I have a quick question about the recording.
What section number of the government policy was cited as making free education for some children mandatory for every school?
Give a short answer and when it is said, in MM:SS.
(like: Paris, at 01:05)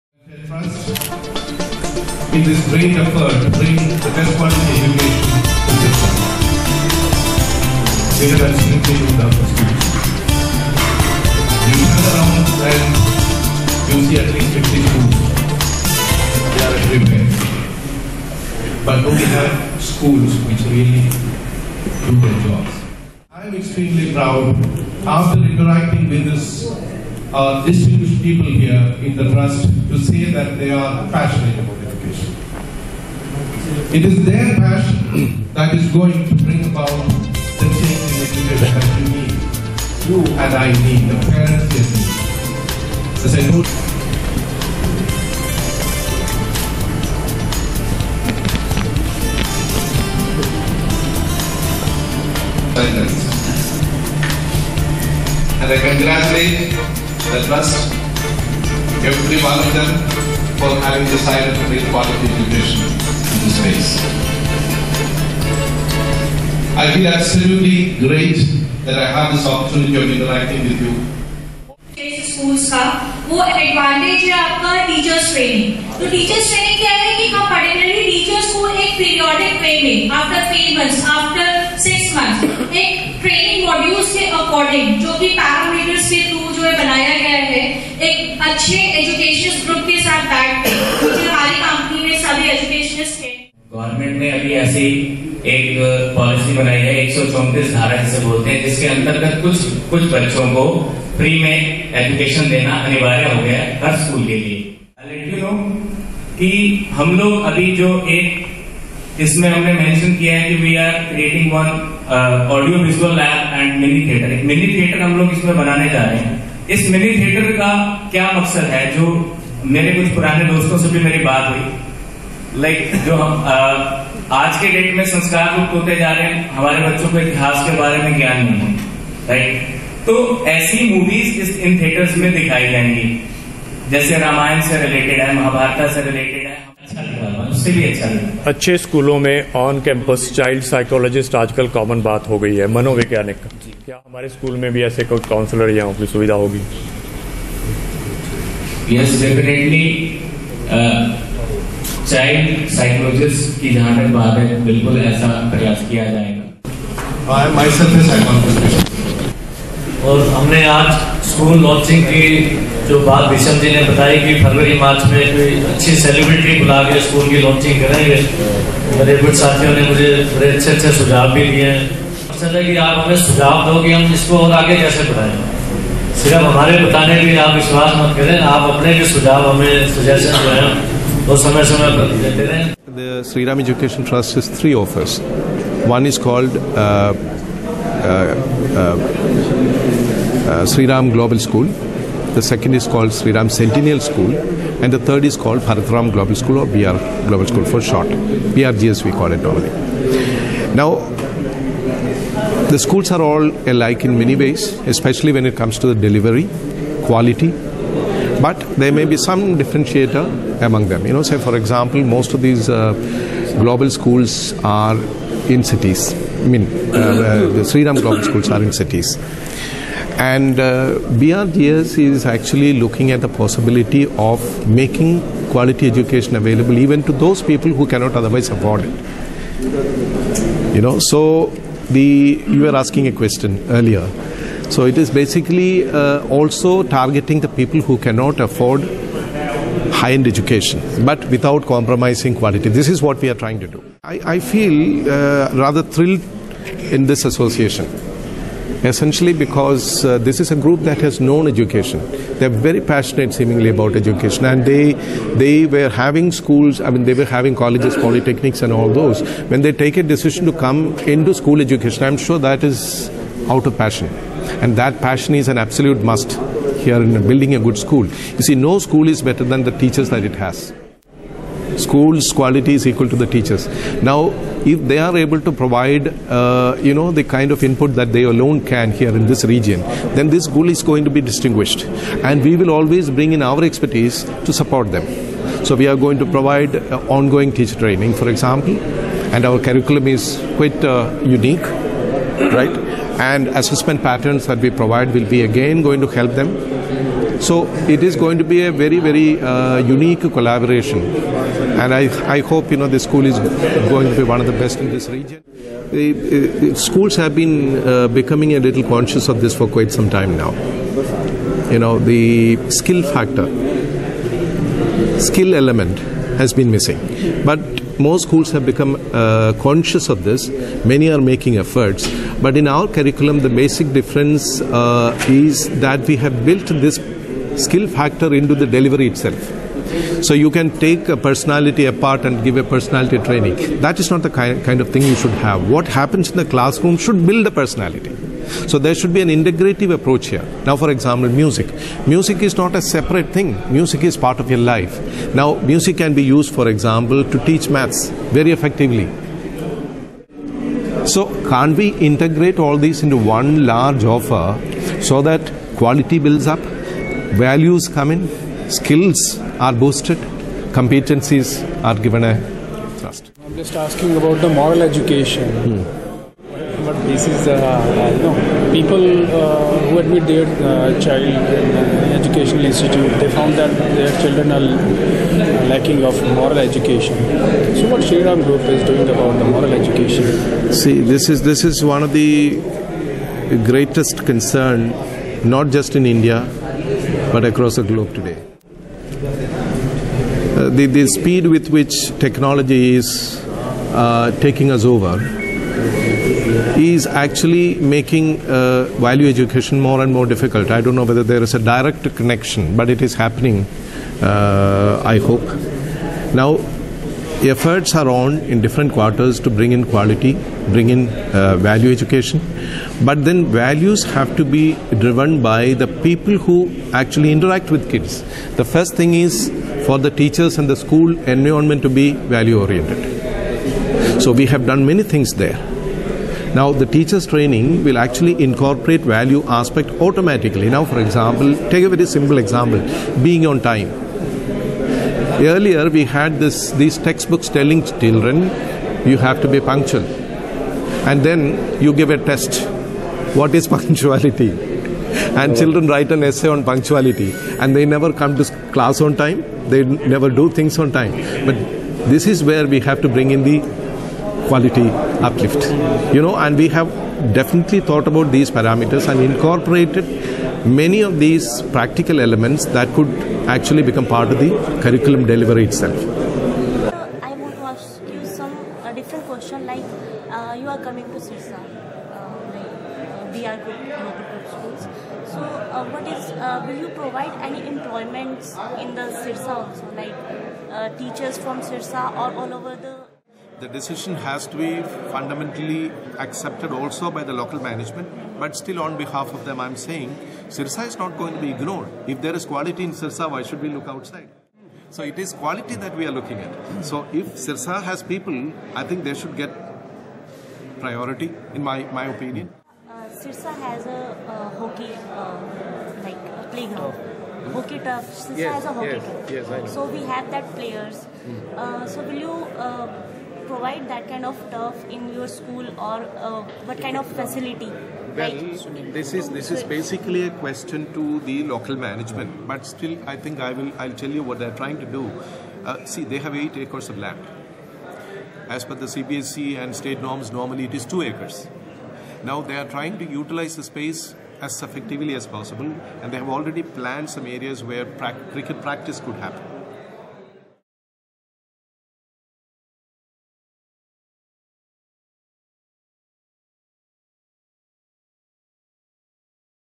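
134, at 01:37.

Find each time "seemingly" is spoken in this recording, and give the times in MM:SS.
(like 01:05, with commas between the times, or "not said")
04:13.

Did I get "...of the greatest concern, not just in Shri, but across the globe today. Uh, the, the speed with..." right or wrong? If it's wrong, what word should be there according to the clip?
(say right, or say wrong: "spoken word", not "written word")
wrong: "India", not "Shri".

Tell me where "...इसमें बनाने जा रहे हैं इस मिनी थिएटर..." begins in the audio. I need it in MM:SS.
01:55.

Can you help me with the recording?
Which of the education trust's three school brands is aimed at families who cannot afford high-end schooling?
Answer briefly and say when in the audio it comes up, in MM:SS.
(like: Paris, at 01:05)
Bharatram Global School, at 03:15.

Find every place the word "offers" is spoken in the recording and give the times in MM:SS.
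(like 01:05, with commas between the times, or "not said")
03:04, 05:54.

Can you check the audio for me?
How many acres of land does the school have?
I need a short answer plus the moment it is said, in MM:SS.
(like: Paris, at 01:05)
8 acres, at 08:46.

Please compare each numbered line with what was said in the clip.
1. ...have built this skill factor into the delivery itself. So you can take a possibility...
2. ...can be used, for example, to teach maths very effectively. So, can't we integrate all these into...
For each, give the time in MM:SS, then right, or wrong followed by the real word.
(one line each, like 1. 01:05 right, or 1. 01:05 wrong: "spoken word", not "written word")
1. 05:26 wrong: "personality", not "possibility"
2. 05:45 right.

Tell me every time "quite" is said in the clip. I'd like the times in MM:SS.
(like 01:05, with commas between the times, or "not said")
04:50, 05:09.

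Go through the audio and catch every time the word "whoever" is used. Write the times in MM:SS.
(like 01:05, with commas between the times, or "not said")
not said.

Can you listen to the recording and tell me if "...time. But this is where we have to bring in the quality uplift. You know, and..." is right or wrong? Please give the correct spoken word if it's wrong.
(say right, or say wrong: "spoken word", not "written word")
right.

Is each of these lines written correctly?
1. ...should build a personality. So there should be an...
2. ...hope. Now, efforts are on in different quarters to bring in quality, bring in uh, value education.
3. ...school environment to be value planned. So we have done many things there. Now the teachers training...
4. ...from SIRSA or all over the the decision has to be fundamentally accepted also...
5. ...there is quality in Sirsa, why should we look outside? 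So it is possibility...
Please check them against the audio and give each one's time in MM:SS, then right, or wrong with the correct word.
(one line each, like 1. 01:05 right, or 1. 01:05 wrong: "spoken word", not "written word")
1. 05:36 right
2. 06:45 right
3. 07:00 wrong: "oriented", not "planned"
4. 08:01 right
5. 08:12 wrong: "quality", not "possibility".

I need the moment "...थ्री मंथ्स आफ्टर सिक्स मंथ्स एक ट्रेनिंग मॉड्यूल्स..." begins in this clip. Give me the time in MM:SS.
01:20.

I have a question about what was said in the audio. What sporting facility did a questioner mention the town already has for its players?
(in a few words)
Hockey turf.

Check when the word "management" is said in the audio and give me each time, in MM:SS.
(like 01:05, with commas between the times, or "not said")
08:07, 08:41.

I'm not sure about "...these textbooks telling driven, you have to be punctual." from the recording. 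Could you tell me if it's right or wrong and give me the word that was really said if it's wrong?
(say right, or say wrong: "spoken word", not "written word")
wrong: "children", not "driven".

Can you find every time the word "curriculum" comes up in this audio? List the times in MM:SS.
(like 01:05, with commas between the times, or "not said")
04:49, 05:22, 07:44.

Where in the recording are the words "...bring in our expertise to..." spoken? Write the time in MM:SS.
04:43.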